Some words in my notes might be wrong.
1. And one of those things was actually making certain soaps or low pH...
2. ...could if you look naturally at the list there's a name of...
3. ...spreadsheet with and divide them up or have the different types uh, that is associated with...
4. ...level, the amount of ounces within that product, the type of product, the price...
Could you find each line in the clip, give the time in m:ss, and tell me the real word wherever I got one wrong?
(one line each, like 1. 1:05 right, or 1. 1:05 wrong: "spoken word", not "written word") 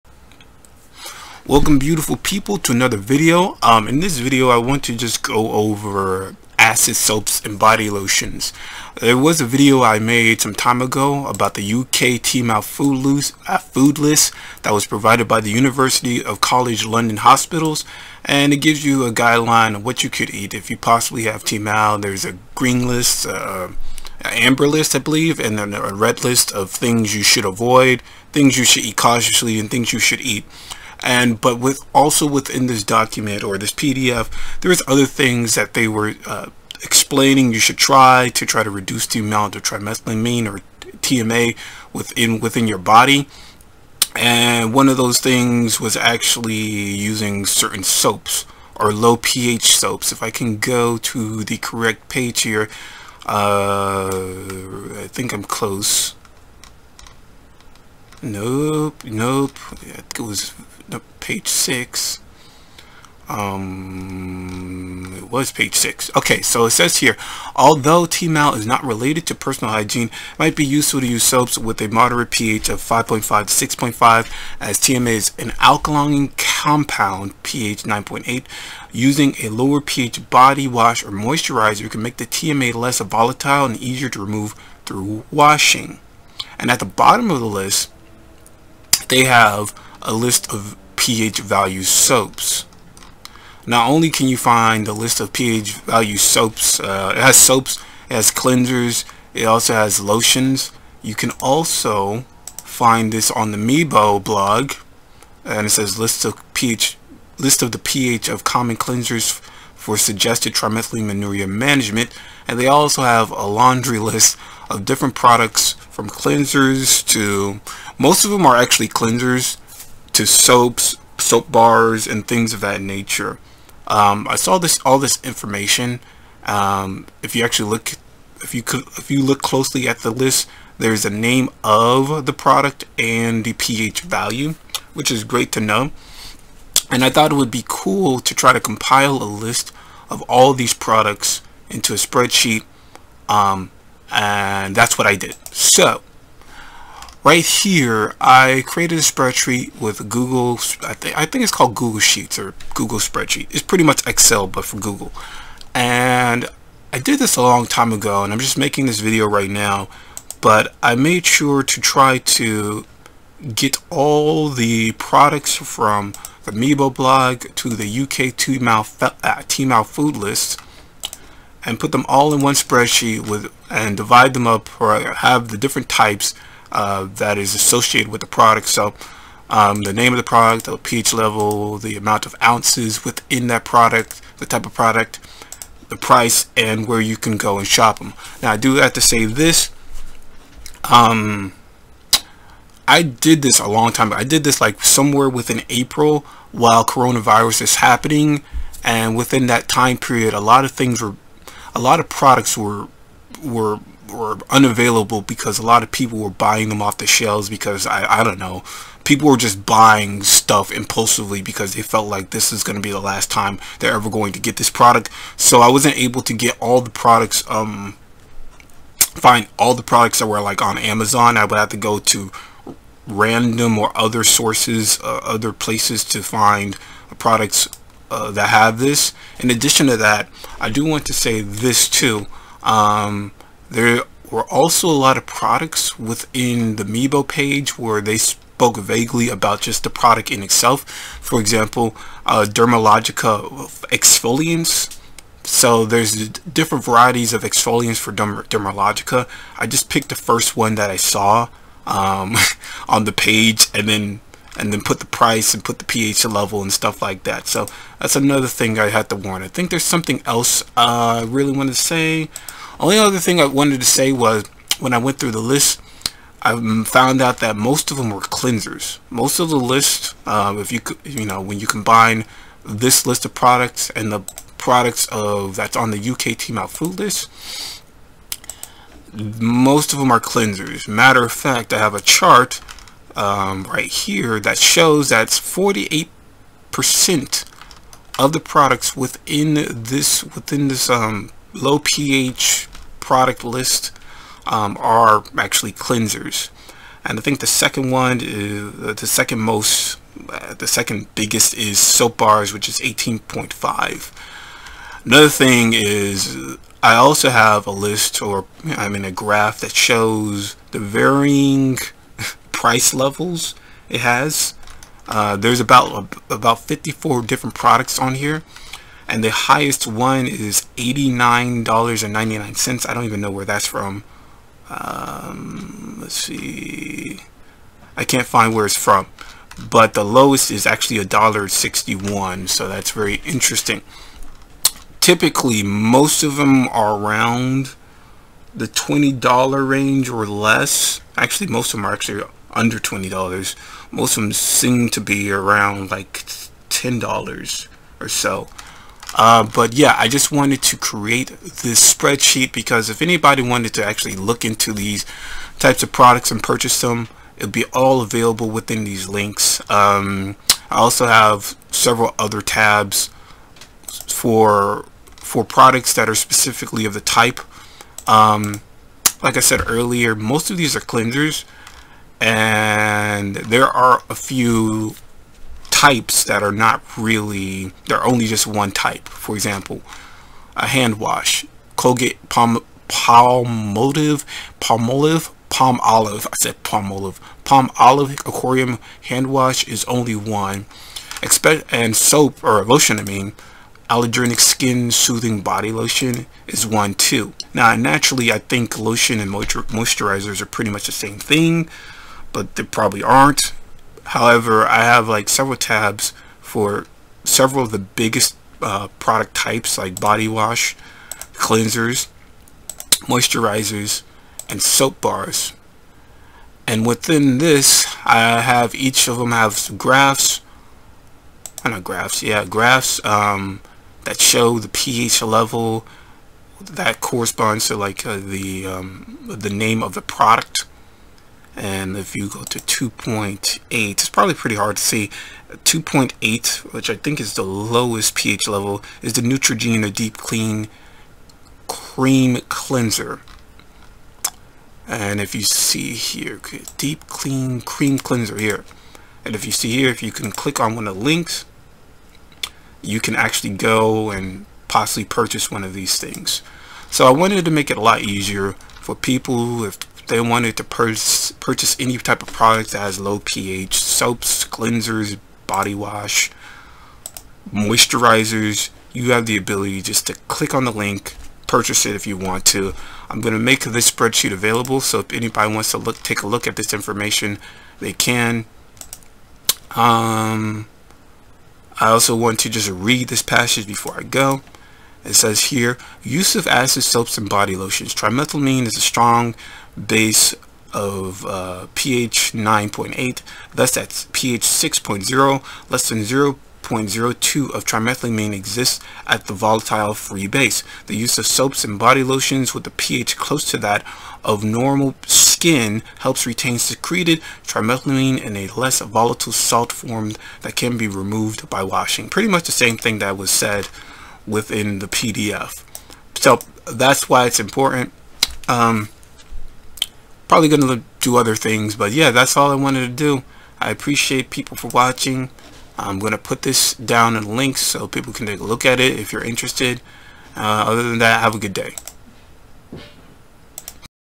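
1. 0:44 wrong: "using", not "making"
2. 2:08 wrong: "closely", not "naturally"
3. 2:52 right
4. 3:01 right.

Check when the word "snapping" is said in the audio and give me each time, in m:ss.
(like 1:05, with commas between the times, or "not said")
not said.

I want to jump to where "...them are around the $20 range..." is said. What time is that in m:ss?
5:36.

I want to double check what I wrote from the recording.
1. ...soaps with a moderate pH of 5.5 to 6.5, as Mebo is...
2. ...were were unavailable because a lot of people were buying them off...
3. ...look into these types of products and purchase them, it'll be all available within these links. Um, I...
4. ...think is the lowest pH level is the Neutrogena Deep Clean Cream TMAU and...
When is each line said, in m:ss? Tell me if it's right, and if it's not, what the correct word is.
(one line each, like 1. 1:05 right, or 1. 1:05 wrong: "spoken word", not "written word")
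1. 1:11 wrong: "TMA", not "Mebo"
2. 3:23 right
3. 5:54 right
4. 7:16 wrong: "Cleanser", not "TMAU".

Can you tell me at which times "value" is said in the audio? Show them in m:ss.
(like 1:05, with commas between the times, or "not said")
1:31, 1:35, 2:14.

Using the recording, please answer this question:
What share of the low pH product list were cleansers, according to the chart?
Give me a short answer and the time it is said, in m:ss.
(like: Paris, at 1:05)
48 percent, at 4:45.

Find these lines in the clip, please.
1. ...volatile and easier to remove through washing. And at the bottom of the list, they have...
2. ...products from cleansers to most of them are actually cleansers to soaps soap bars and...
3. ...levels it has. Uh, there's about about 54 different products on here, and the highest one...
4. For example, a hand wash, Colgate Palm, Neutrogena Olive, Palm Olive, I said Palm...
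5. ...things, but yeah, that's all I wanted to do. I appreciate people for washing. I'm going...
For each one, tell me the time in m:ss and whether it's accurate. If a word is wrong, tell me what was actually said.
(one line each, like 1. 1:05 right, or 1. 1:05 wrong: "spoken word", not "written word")
1. 1:22 right
2. 1:55 right
3. 5:12 right
4. 6:19 wrong: "Palm", not "Neutrogena"
5. 8:41 wrong: "watching", not "washing".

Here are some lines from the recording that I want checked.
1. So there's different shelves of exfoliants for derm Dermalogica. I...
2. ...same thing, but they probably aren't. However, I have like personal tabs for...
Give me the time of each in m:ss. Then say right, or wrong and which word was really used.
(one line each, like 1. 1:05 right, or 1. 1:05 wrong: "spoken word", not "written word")
1. 4:05 wrong: "varieties", not "shelves"
2. 6:40 wrong: "several", not "personal".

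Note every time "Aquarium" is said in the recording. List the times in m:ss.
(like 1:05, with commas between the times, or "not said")
6:28.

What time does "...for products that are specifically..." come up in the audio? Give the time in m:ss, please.
6:05.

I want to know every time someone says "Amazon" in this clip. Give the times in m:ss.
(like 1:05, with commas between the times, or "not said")
3:40.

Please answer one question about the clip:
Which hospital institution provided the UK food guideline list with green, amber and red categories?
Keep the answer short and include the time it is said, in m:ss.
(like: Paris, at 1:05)
University of College London Hospitals, at 0:15.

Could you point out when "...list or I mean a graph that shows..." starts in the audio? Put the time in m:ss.
5:07.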